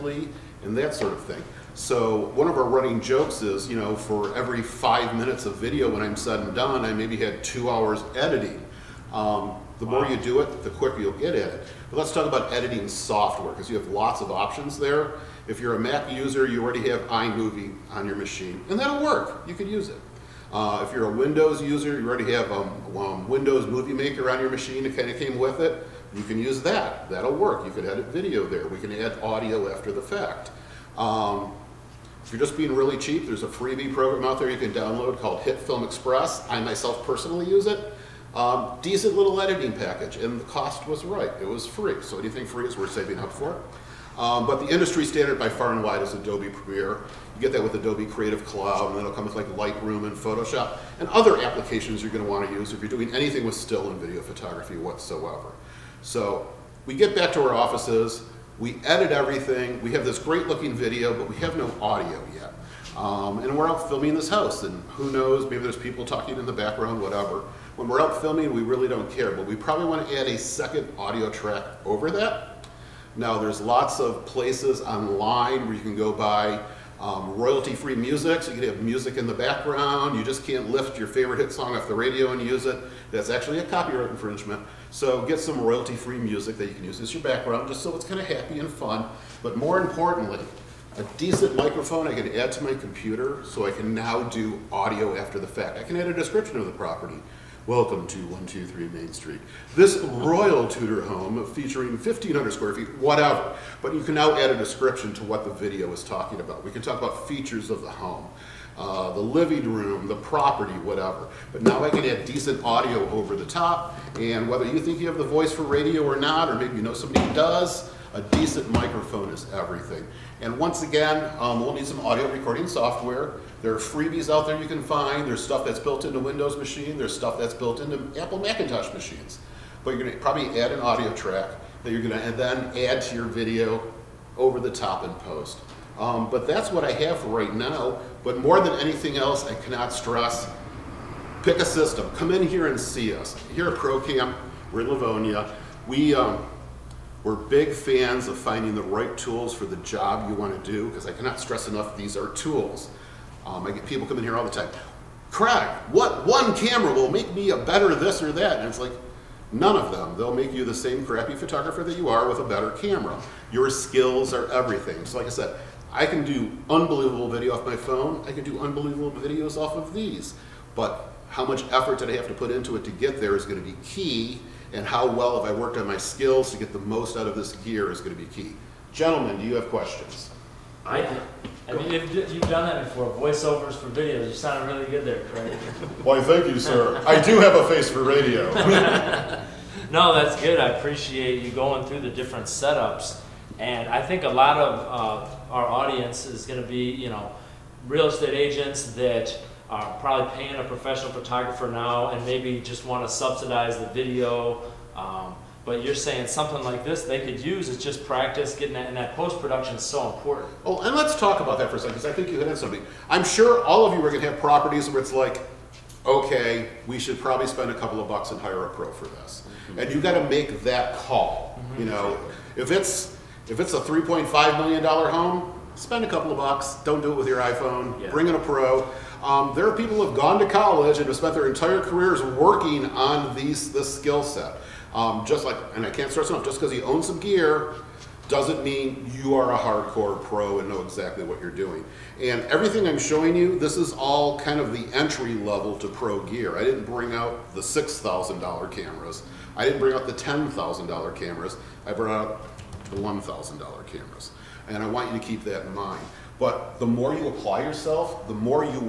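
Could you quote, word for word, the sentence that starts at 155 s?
Craig, what one camera will make me a better this or that?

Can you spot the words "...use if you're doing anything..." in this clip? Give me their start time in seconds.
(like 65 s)
52 s.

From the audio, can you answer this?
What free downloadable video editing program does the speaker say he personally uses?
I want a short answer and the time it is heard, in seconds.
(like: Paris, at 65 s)
HitFilm Express, at 35 s.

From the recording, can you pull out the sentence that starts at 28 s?
We can add audio after the fact.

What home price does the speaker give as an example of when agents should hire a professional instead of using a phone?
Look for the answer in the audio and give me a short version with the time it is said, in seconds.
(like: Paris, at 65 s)
3.5 million dollars, at 223 s.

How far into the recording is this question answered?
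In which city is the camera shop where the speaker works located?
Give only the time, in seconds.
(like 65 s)
144 s.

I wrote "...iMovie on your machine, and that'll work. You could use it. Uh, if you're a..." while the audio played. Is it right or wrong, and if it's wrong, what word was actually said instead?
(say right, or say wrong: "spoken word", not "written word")
right.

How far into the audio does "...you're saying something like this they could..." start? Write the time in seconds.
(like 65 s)
205 s.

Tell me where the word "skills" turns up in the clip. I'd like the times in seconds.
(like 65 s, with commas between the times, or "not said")
163 s, 175 s, 233 s.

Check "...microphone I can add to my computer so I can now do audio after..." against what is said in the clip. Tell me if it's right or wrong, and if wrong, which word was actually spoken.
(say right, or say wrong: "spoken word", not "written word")
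right.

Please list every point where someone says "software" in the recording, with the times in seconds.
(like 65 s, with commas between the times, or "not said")
12 s, 122 s.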